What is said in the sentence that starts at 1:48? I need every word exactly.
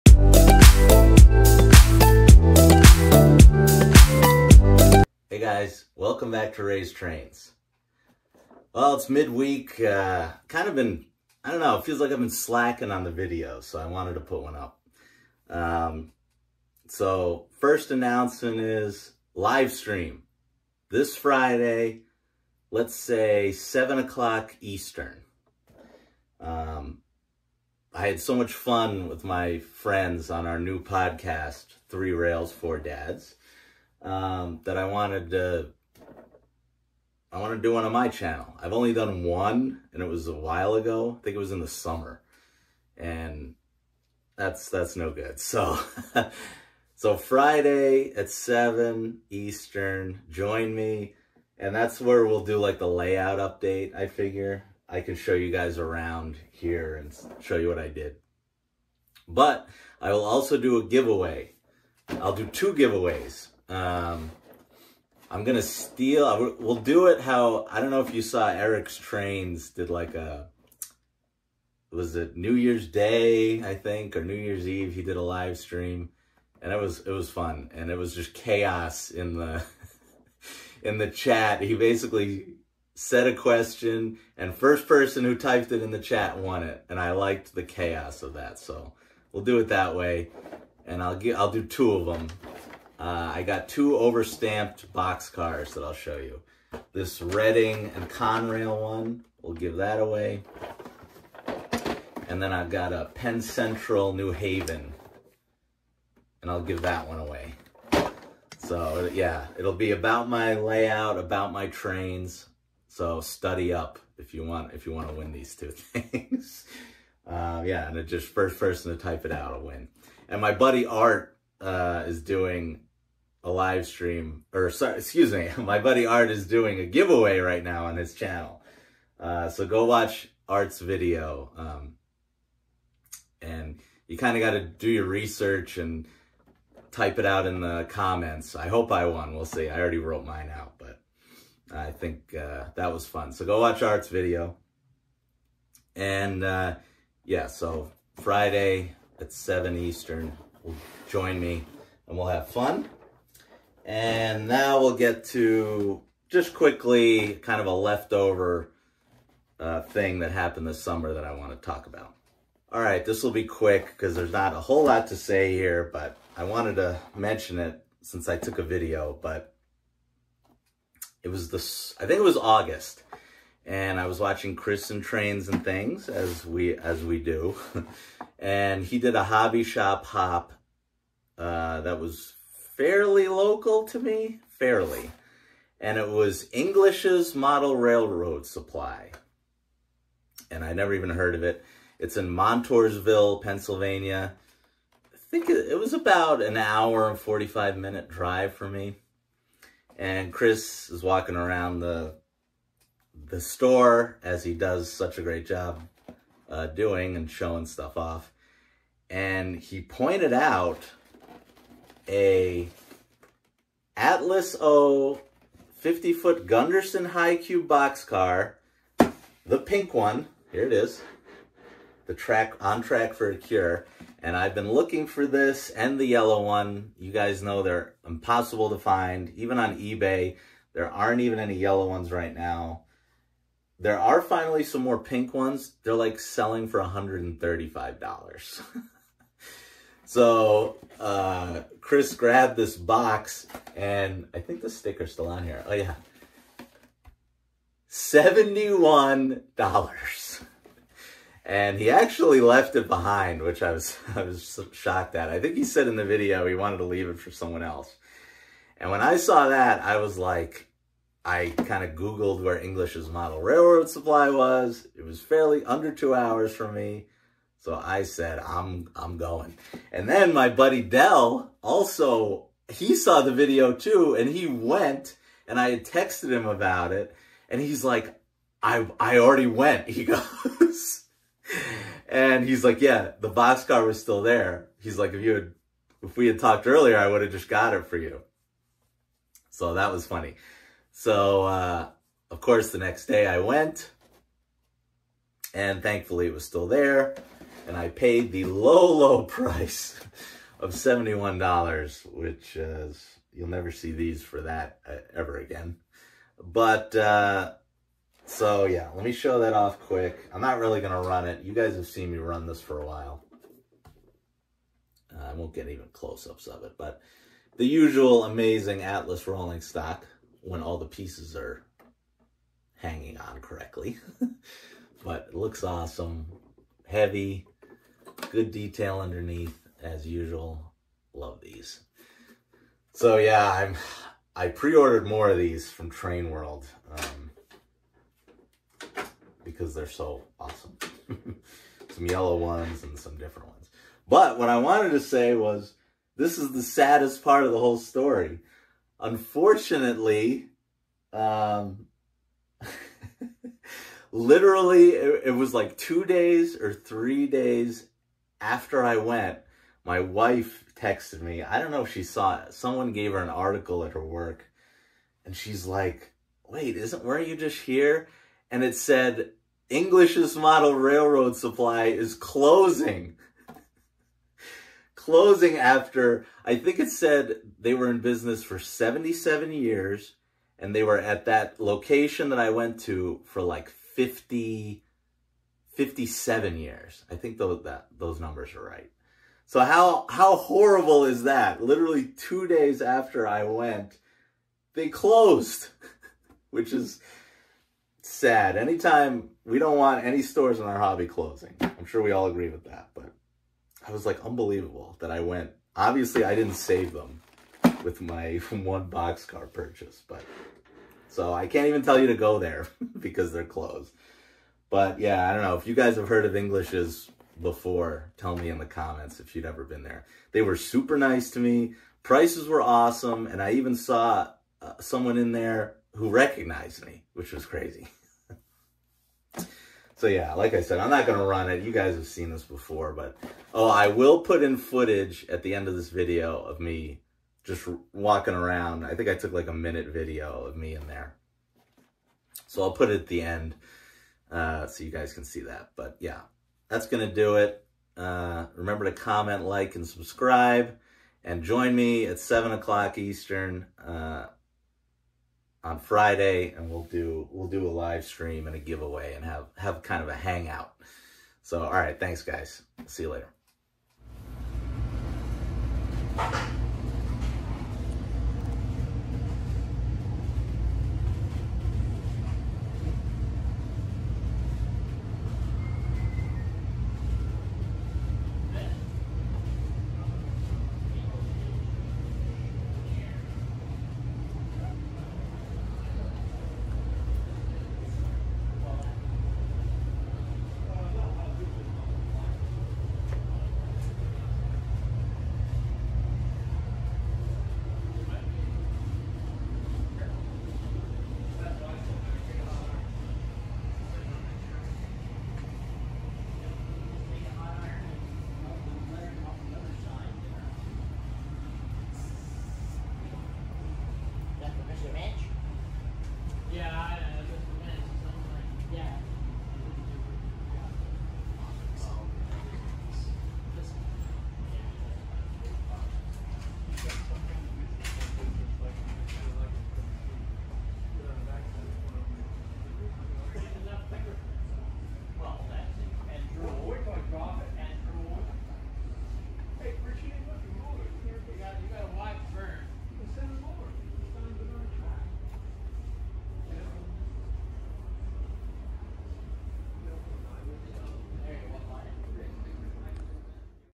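So yeah, it'll be about my layout, about my trains.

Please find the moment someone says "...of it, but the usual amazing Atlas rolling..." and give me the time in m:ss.
5:16.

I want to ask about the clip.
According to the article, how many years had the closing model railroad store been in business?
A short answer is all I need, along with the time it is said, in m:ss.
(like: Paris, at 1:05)
77, at 6:18.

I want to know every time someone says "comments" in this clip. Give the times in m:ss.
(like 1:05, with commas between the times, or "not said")
2:17, 6:58, 7:28.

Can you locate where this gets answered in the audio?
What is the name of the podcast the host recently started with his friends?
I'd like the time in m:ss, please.
0:31.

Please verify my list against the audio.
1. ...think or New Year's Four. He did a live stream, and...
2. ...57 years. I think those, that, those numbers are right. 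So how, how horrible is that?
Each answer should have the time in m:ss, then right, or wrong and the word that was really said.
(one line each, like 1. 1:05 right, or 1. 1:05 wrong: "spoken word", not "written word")
1. 1:13 wrong: "Eve", not "Four"
2. 6:25 right.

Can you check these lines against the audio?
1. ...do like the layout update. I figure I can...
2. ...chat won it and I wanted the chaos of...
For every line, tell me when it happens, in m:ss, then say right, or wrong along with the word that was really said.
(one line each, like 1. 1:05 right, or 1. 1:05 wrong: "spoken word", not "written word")
1. 0:52 right
2. 1:25 wrong: "liked", not "wanted".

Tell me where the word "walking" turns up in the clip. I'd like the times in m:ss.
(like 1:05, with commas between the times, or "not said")
3:21, 7:17.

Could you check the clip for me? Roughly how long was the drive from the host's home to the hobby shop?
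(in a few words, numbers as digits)
1 hour 45 minutes.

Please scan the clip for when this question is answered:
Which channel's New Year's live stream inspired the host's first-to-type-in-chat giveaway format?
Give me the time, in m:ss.
1:08.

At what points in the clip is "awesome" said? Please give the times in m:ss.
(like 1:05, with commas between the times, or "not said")
5:25, 5:40, 7:02.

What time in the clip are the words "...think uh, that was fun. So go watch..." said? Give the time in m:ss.
2:21.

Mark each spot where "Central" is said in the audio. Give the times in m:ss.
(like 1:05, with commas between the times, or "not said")
1:43.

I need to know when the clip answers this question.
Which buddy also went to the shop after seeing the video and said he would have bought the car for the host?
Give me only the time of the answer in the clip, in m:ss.
4:30.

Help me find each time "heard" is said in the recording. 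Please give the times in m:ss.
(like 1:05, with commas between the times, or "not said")
3:11, 6:56.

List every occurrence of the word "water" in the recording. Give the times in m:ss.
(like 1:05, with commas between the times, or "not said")
not said.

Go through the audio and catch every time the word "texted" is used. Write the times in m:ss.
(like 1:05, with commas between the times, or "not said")
4:35, 6:00.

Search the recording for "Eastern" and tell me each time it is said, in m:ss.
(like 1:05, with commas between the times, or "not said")
0:24, 0:49, 2:29, 7:32.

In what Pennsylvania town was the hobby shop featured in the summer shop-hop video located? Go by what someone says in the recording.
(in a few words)
Montoursville.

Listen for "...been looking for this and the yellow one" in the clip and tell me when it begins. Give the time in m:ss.
3:44.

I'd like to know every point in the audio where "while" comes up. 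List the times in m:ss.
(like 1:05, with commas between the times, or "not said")
0:40, 5:12.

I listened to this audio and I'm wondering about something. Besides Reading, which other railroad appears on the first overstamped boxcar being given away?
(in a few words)
Conrail.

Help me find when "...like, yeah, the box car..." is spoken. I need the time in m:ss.
4:42.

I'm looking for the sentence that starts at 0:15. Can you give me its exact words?
Um, so, first announcement is live stream.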